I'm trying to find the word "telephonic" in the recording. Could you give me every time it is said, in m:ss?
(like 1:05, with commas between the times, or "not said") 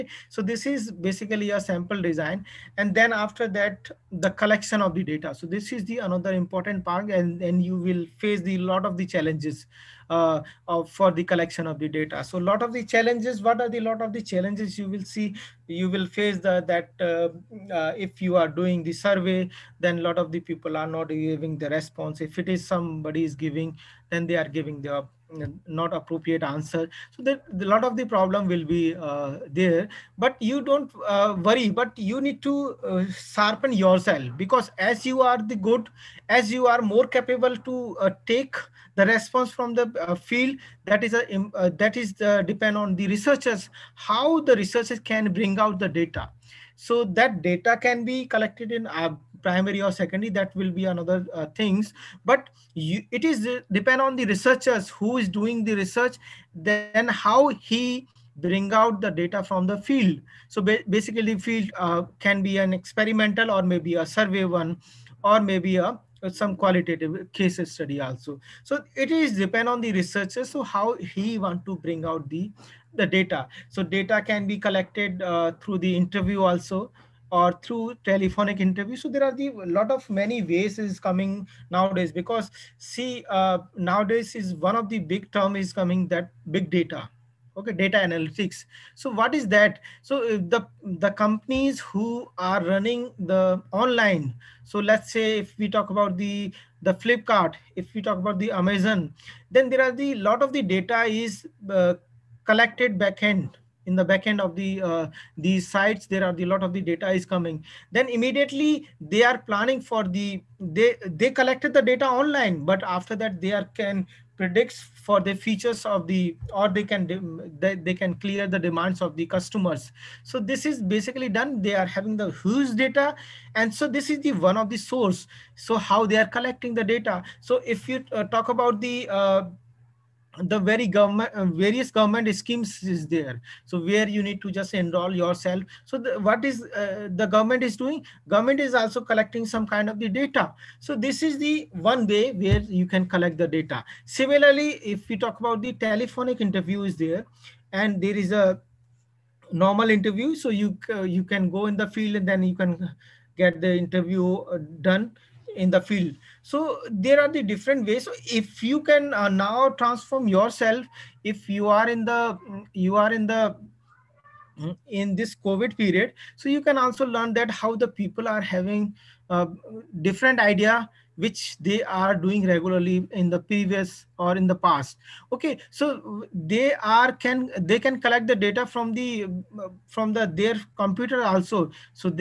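1:18, 2:25.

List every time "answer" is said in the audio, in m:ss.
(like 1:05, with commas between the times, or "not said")
0:26.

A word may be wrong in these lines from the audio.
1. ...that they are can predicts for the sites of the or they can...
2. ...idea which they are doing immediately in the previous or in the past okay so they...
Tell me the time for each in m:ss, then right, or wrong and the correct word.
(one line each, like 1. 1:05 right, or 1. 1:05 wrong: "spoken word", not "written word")
1. 1:53 wrong: "features", not "sites"
2. 2:50 wrong: "regularly", not "immediately".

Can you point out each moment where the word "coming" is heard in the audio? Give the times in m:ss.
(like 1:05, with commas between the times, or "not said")
1:20, 1:25, 1:47.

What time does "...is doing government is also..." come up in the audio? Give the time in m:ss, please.
2:17.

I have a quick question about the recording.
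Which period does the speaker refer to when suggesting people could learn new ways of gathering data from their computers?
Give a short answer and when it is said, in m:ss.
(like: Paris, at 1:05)
COVID period, at 2:45.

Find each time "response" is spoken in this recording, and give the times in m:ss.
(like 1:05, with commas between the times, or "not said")
0:21, 0:39.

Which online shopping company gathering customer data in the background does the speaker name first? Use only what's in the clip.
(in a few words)
Flipkart.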